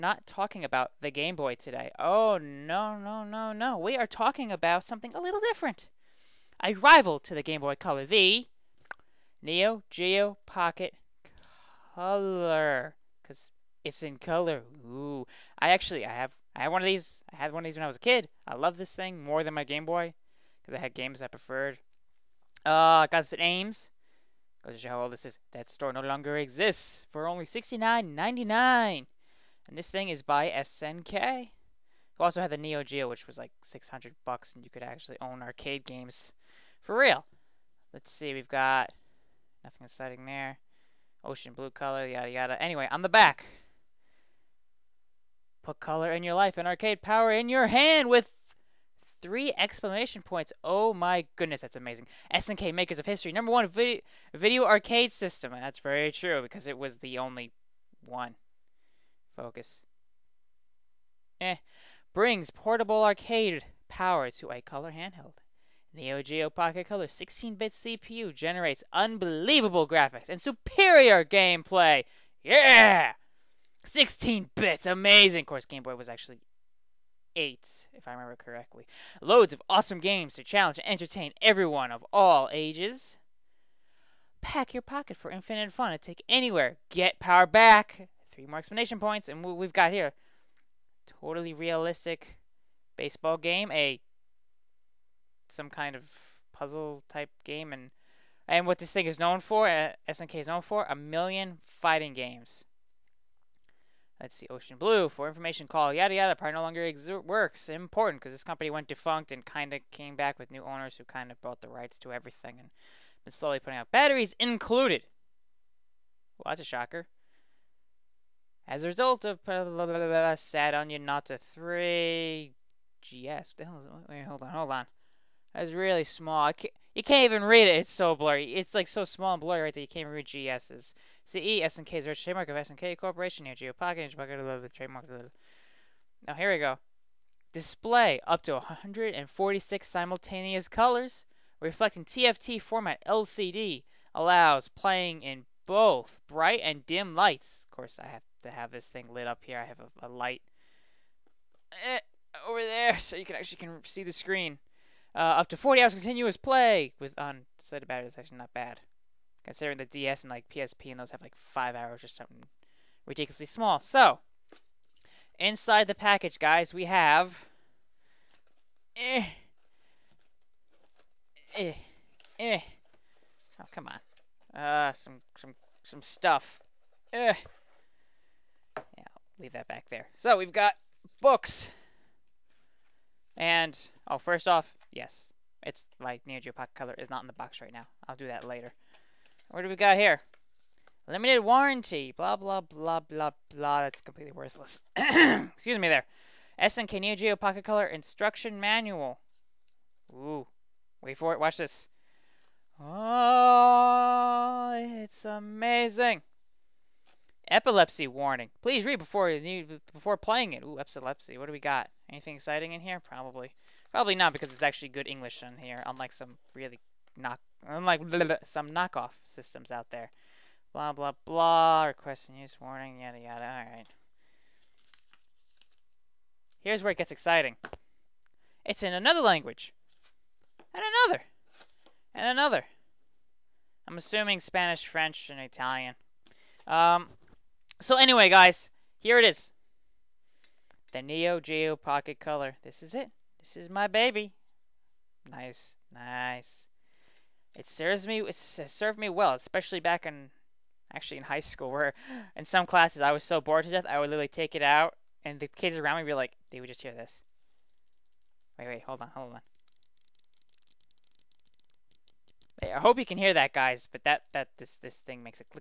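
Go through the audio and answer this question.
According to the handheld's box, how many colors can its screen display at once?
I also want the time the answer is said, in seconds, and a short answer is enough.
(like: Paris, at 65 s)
146, at 138 s.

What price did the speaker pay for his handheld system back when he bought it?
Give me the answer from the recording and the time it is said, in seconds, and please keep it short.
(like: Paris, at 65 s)
$69.99, at 27 s.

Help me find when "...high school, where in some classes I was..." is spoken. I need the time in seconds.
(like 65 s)
251 s.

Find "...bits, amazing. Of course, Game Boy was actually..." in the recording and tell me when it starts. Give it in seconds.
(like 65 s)
74 s.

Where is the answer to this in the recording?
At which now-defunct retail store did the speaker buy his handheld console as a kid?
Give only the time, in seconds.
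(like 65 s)
23 s.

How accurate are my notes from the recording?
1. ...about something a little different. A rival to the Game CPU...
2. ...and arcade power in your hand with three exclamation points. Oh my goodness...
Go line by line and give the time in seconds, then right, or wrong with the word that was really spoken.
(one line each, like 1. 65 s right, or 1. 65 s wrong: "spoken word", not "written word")
1. 4 s wrong: "Boy", not "CPU"
2. 46 s right.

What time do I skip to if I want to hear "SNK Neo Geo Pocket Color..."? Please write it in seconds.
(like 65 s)
196 s.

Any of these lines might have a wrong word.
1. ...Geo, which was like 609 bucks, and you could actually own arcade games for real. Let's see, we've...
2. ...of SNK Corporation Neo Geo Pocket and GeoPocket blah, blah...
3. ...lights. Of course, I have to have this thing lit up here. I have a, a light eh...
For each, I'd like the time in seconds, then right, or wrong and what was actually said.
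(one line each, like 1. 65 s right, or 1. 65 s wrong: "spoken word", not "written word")
1. 32 s wrong: "600", not "609"
2. 132 s right
3. 147 s right.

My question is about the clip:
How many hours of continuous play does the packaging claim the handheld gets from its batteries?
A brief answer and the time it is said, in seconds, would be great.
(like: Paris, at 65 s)
40 hours, at 155 s.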